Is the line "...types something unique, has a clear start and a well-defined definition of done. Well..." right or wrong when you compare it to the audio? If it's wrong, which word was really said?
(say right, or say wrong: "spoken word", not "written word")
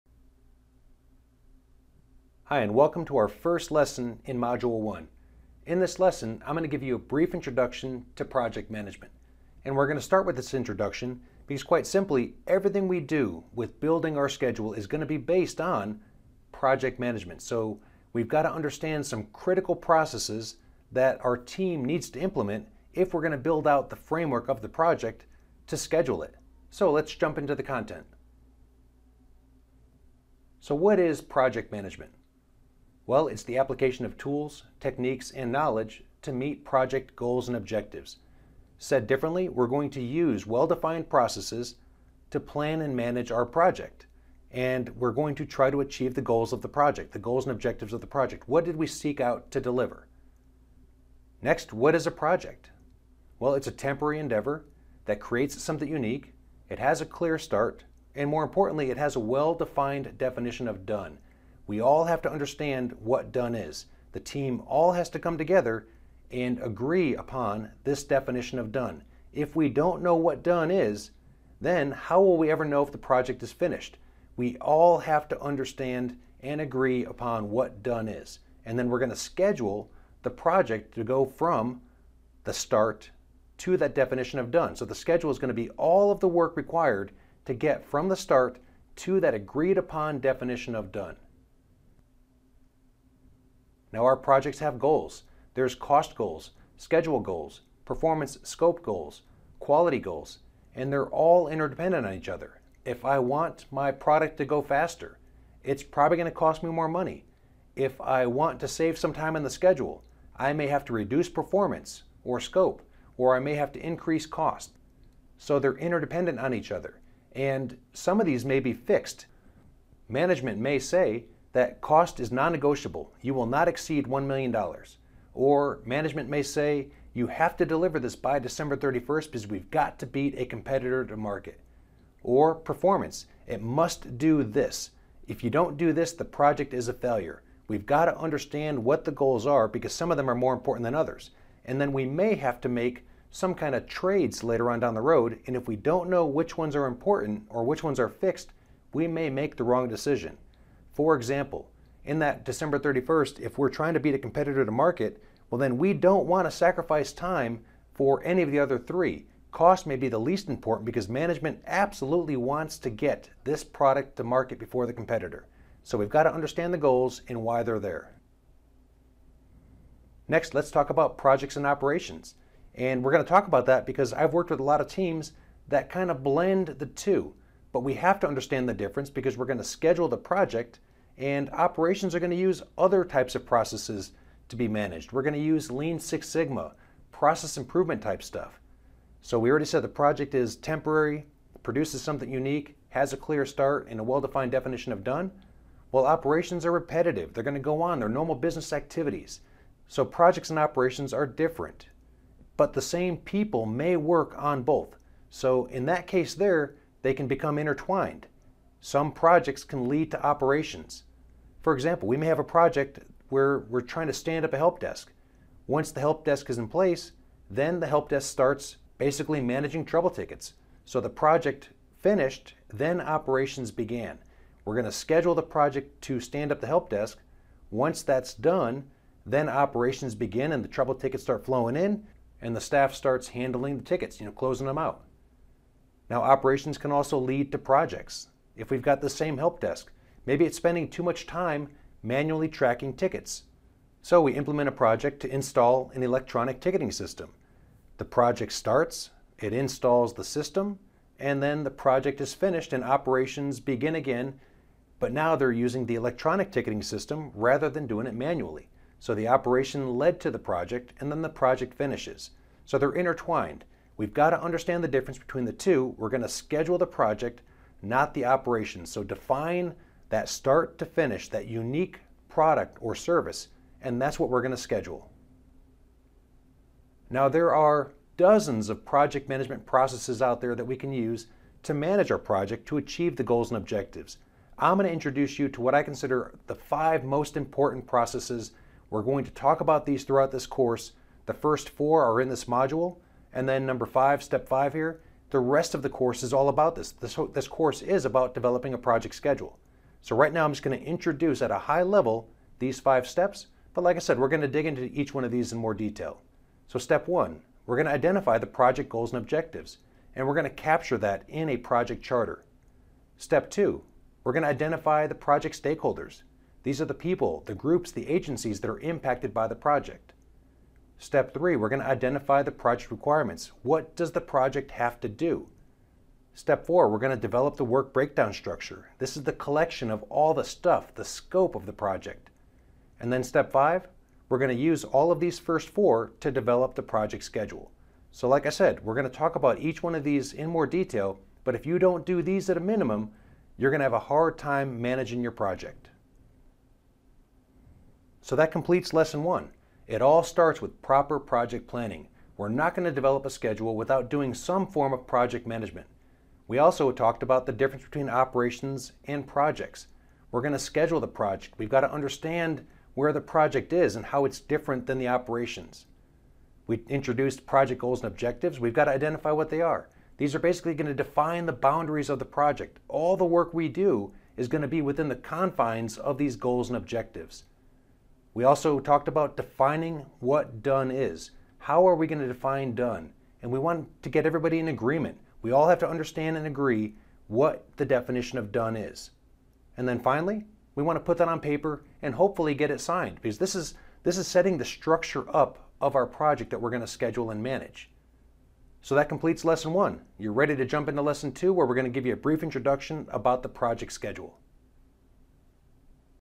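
wrong: "produces", not "types".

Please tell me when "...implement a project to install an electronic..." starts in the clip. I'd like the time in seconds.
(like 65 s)
244 s.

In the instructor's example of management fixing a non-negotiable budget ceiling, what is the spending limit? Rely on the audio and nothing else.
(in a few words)
$1 million.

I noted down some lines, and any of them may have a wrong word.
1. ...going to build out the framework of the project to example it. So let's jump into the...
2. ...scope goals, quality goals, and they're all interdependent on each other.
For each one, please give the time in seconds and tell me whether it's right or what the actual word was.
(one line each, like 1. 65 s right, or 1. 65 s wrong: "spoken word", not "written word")
1. 23 s wrong: "schedule", not "example"
2. 98 s right.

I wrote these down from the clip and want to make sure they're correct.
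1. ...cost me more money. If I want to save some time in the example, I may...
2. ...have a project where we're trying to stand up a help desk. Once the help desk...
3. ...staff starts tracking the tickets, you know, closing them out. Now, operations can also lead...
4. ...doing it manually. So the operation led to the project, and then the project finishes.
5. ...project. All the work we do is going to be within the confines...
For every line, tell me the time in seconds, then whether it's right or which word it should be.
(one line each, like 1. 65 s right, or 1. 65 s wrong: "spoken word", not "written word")
1. 106 s wrong: "schedule", not "example"
2. 212 s right
3. 232 s wrong: "handling", not "tracking"
4. 257 s right
5. 372 s right.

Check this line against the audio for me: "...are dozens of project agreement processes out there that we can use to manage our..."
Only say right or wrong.
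wrong.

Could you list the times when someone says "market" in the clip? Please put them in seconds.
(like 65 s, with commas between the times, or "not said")
131 s, 154 s, 164 s.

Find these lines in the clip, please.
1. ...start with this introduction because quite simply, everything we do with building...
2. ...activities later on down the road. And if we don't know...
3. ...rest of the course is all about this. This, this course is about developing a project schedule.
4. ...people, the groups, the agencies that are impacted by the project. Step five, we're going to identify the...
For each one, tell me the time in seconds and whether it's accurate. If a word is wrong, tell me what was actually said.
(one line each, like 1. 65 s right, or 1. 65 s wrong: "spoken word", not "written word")
1. 10 s right
2. 143 s wrong: "trades", not "activities"
3. 295 s right
4. 316 s wrong: "three", not "five".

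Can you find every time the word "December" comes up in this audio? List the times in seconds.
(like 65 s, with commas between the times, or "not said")
128 s, 152 s.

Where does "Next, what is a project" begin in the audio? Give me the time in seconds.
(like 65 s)
51 s.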